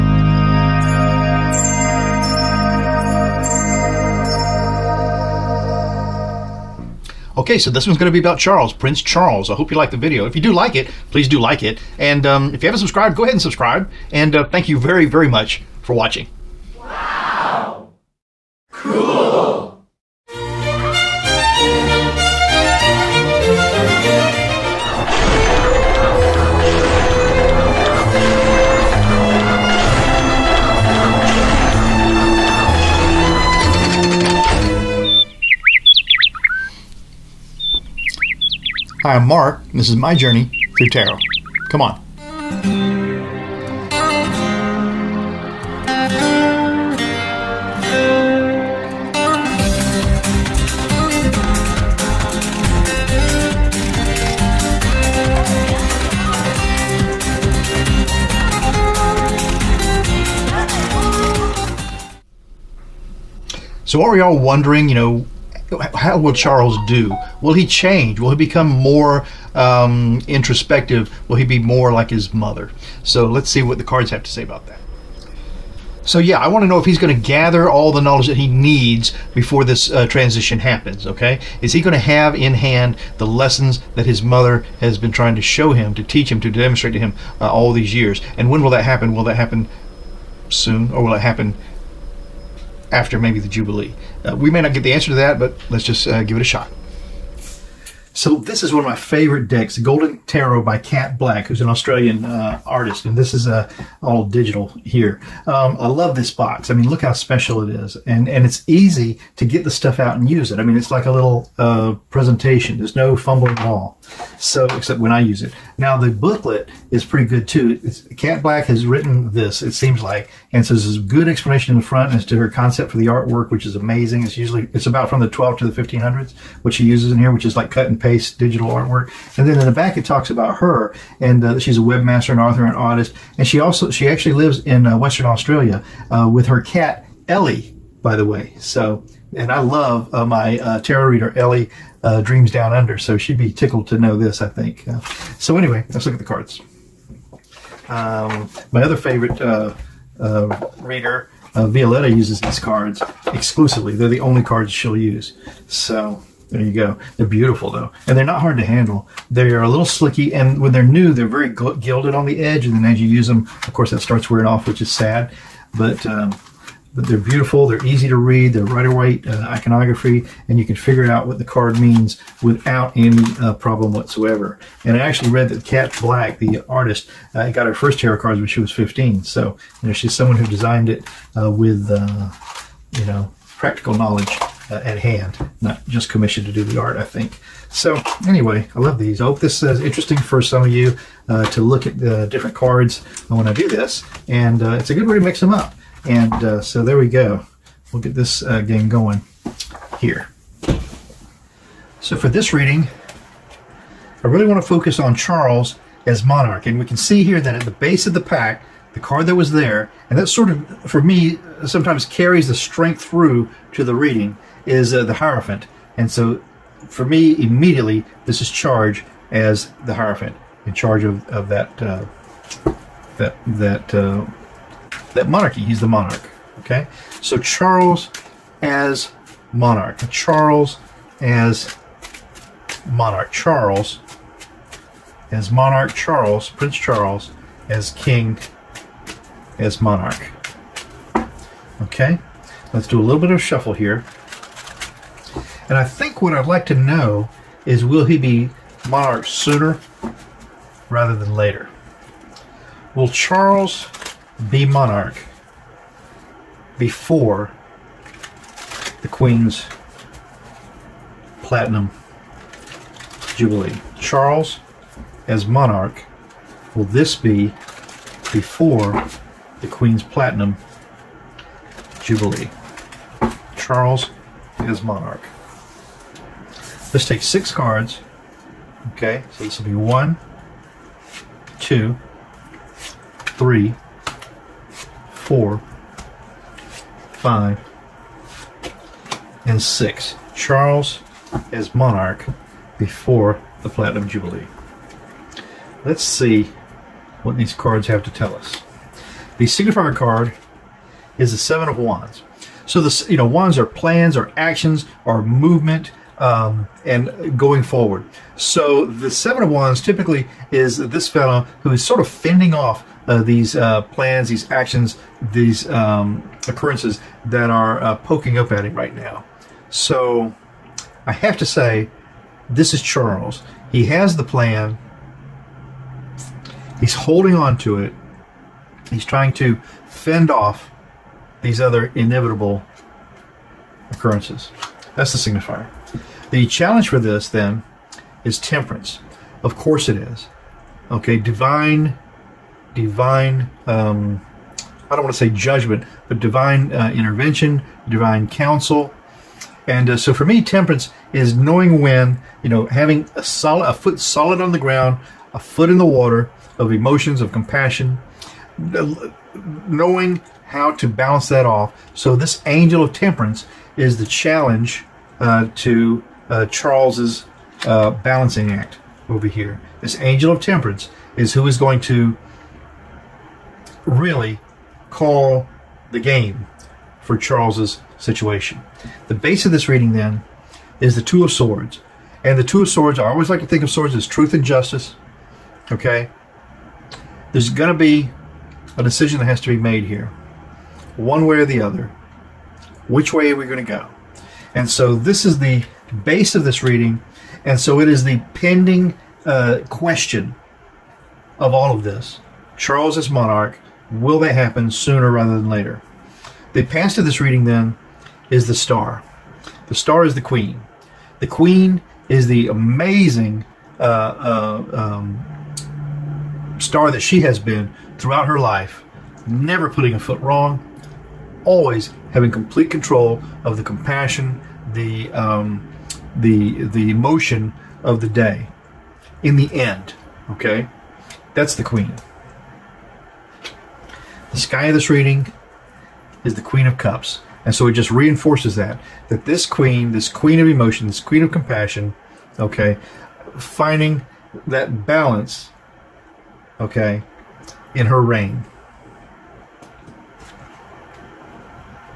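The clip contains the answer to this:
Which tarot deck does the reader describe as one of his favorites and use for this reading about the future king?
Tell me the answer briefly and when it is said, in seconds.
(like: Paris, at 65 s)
Golden Tarot, at 99 s.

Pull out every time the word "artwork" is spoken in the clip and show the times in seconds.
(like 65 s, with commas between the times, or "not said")
123 s, 128 s.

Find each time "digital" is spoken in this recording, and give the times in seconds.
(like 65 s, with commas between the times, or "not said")
104 s, 128 s.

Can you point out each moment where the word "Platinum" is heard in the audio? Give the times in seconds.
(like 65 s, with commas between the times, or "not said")
261 s, 270 s, 293 s.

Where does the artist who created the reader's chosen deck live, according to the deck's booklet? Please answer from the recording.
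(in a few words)
Western Australia.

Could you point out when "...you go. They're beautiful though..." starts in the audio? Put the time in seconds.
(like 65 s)
156 s.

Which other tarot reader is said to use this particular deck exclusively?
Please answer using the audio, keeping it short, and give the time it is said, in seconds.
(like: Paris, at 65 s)
Violetta, at 151 s.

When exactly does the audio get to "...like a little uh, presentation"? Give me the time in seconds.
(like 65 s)
110 s.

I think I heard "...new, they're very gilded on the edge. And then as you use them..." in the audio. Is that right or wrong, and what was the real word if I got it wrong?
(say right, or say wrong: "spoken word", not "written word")
right.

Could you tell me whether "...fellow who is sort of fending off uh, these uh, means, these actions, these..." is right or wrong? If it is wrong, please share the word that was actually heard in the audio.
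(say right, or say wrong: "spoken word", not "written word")
wrong: "plans", not "means".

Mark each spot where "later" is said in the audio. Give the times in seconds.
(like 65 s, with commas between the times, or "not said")
251 s, 405 s.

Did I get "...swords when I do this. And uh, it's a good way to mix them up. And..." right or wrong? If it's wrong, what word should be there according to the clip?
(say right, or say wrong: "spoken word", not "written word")
wrong: "cards", not "swords".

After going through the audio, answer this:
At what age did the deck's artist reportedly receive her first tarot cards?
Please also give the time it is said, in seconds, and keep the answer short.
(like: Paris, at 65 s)
15, at 178 s.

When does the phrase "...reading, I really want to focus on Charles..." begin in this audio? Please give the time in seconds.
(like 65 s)
202 s.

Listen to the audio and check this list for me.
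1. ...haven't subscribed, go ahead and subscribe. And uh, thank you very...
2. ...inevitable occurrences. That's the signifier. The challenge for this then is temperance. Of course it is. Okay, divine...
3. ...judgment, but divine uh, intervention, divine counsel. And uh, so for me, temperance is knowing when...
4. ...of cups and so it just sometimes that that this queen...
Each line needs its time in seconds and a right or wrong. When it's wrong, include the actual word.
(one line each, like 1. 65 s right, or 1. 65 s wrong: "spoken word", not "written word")
1. 12 s right
2. 331 s right
3. 345 s right
4. 436 s wrong: "reinforces", not "sometimes".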